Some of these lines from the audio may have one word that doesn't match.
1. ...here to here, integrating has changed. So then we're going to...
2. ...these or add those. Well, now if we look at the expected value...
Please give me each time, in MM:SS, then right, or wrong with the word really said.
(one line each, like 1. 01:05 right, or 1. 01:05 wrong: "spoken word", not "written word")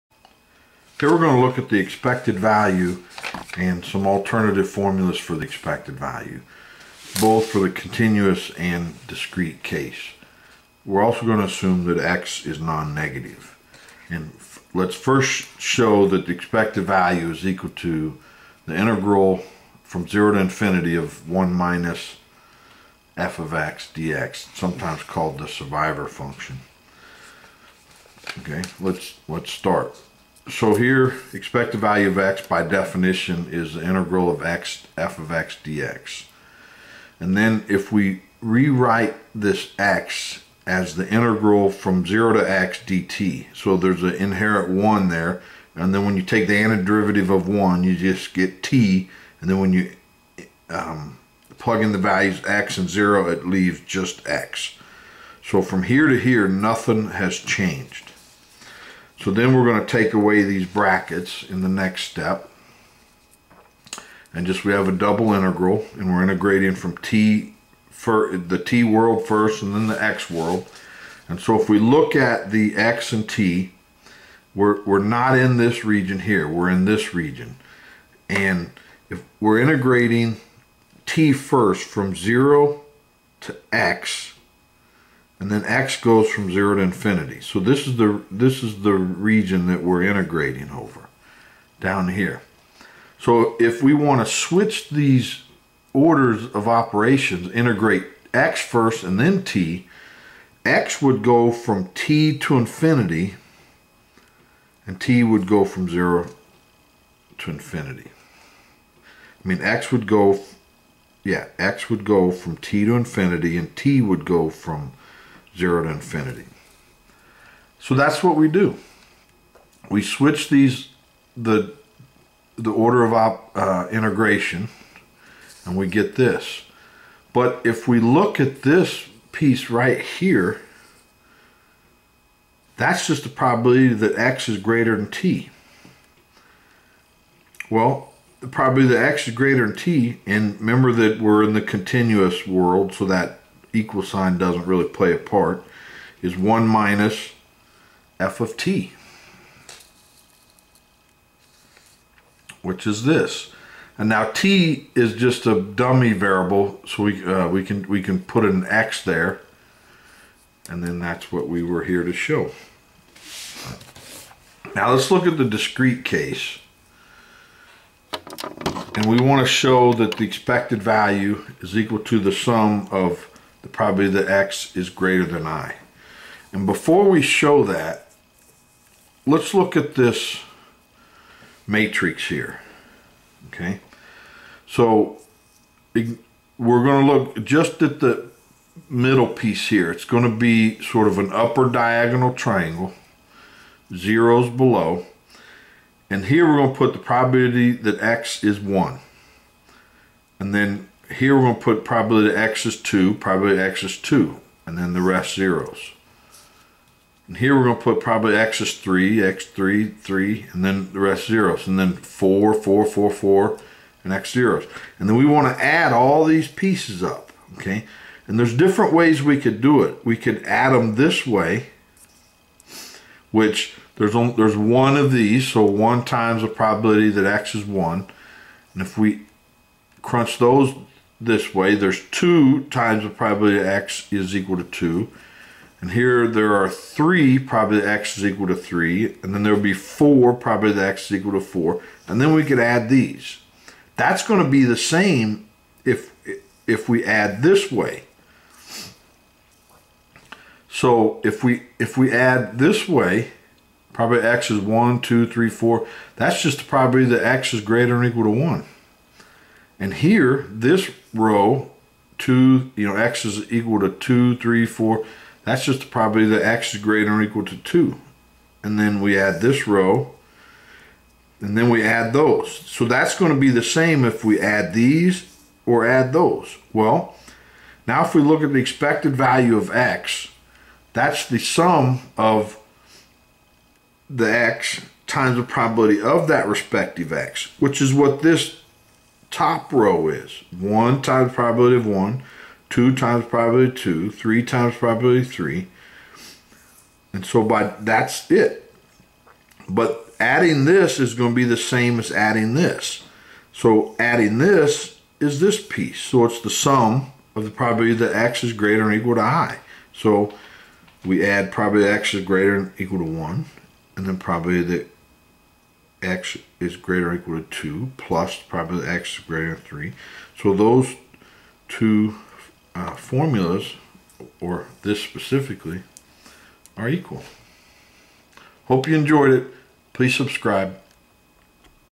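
1. 00:55 wrong: "nothing", not "integrating"
2. 04:34 right.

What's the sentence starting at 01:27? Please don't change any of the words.
So this is the this is the region that we're integrating over down here.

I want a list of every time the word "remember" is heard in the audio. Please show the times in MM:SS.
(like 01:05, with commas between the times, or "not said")
02:20.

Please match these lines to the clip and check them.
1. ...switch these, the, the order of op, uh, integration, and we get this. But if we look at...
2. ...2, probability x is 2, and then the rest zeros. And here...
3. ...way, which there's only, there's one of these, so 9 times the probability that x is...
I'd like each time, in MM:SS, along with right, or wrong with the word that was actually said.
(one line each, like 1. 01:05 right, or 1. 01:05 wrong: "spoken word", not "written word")
1. 02:00 right
2. 03:22 right
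3. 03:41 wrong: "1", not "9".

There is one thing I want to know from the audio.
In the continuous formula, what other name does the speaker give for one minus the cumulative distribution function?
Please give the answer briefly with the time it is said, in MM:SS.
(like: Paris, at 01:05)
survivor function, at 00:25.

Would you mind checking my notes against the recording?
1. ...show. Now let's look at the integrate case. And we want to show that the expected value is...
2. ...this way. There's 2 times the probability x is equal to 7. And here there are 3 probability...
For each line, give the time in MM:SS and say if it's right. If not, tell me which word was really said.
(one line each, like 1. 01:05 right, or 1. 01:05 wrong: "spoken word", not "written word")
1. 02:42 wrong: "discrete", not "integrate"
2. 03:51 wrong: "2", not "7".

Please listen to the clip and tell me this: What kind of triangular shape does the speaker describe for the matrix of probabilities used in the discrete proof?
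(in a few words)
upper diagonal triangle.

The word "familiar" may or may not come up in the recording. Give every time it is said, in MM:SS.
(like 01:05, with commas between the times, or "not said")
not said.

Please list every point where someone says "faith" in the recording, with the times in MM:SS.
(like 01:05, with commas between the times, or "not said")
not said.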